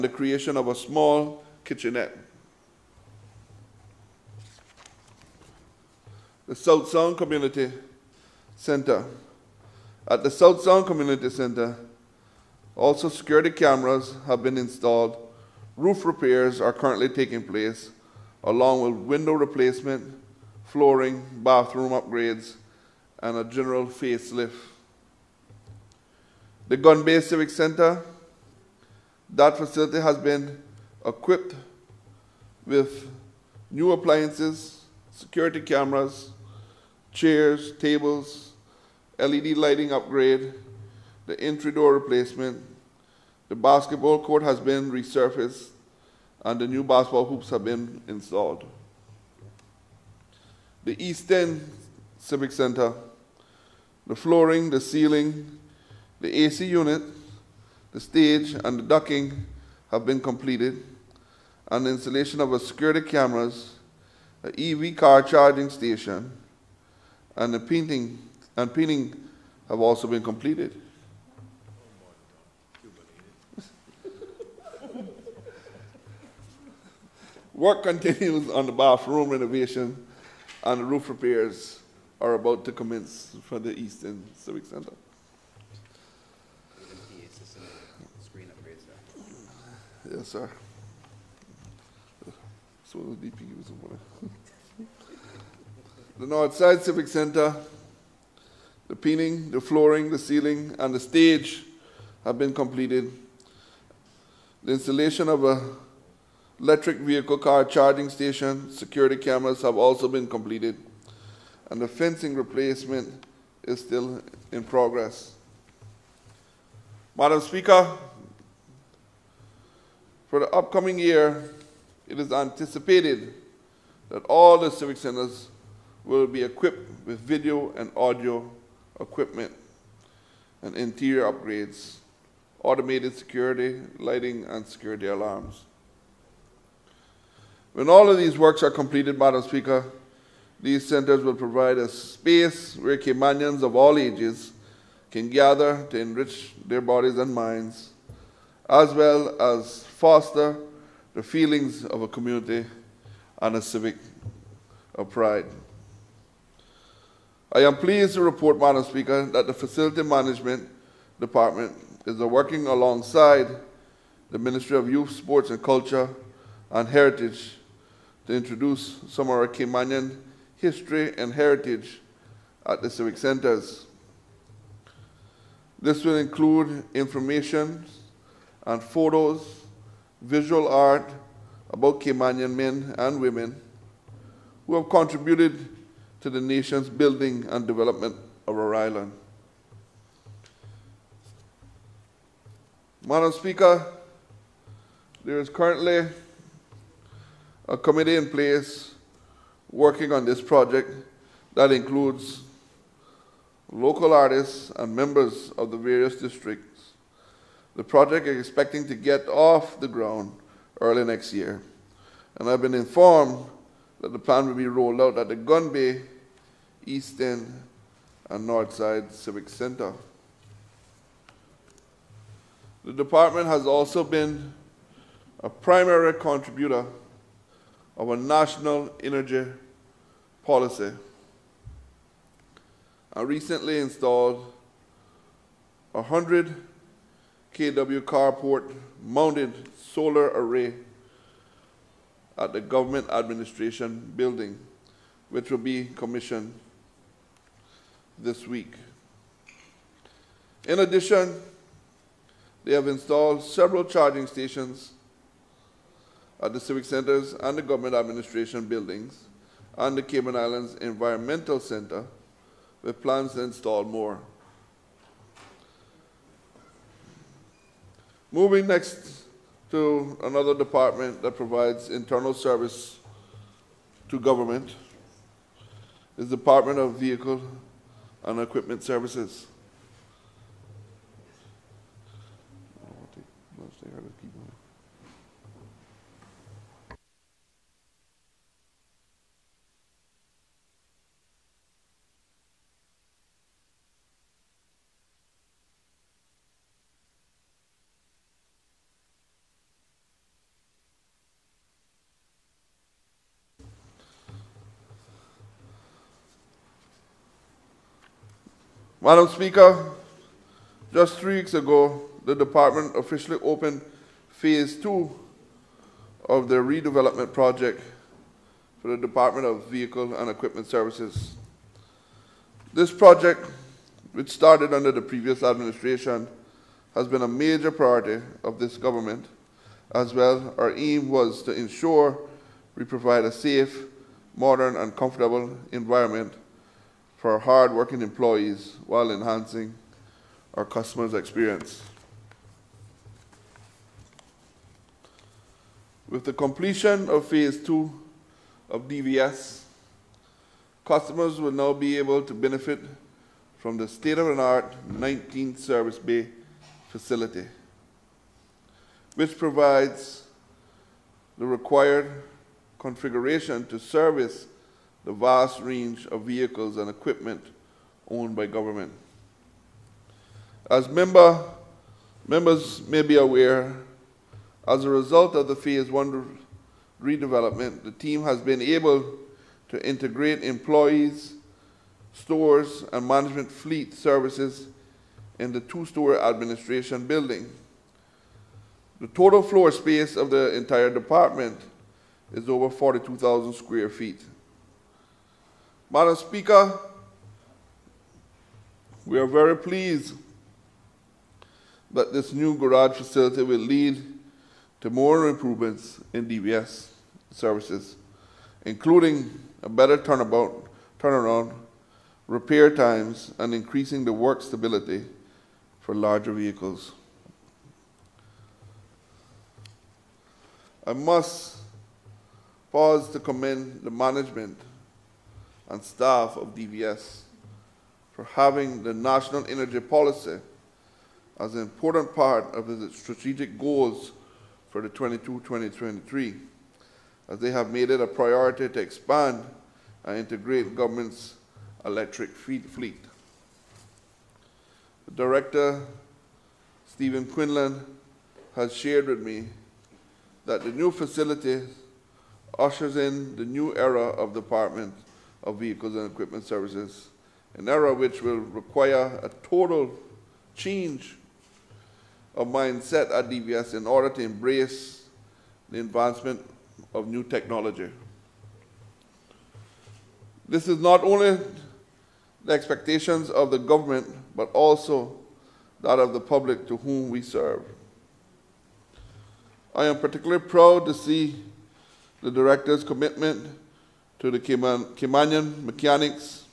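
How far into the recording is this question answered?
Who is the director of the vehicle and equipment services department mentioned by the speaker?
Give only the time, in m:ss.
7:26.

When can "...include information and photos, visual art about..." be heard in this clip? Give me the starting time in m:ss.
2:56.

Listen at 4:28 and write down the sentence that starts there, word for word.
Moving next to another department that provides internal service to government is the Department of Vehicle and Equipment Services.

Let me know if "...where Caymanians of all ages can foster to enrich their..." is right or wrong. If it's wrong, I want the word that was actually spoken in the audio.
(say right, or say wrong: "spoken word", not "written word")
wrong: "gather", not "foster".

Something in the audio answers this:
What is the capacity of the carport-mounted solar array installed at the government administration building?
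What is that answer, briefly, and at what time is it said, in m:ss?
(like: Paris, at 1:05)
100 kW, at 3:56.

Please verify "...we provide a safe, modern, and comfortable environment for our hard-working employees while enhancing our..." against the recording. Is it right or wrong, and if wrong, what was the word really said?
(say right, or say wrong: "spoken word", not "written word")
right.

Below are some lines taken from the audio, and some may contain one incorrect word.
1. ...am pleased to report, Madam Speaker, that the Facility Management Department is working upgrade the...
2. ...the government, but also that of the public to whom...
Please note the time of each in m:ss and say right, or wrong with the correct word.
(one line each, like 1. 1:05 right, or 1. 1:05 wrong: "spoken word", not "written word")
1. 2:37 wrong: "alongside", not "upgrade"
2. 7:53 right.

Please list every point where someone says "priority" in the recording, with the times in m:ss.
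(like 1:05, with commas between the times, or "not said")
5:27, 7:18.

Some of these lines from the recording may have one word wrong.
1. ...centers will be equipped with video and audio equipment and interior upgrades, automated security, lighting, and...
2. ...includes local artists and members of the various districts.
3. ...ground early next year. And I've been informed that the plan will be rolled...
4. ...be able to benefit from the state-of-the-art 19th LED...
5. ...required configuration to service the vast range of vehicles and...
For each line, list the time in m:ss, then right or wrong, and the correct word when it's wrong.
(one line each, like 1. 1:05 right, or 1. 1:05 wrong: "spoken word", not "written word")
1. 2:04 right
2. 3:21 right
3. 3:29 right
4. 5:51 wrong: "Service", not "LED"
5. 6:01 right.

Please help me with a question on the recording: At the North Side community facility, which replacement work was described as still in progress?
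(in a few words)
Fencing replacement.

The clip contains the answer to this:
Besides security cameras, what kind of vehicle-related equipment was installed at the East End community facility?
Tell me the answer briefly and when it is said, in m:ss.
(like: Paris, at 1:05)
EV car charging station, at 1:04.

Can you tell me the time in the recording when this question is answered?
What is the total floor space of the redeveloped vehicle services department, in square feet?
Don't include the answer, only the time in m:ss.
6:32.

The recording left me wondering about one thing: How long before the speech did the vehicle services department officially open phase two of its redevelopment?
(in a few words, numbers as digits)
Three weeks ago.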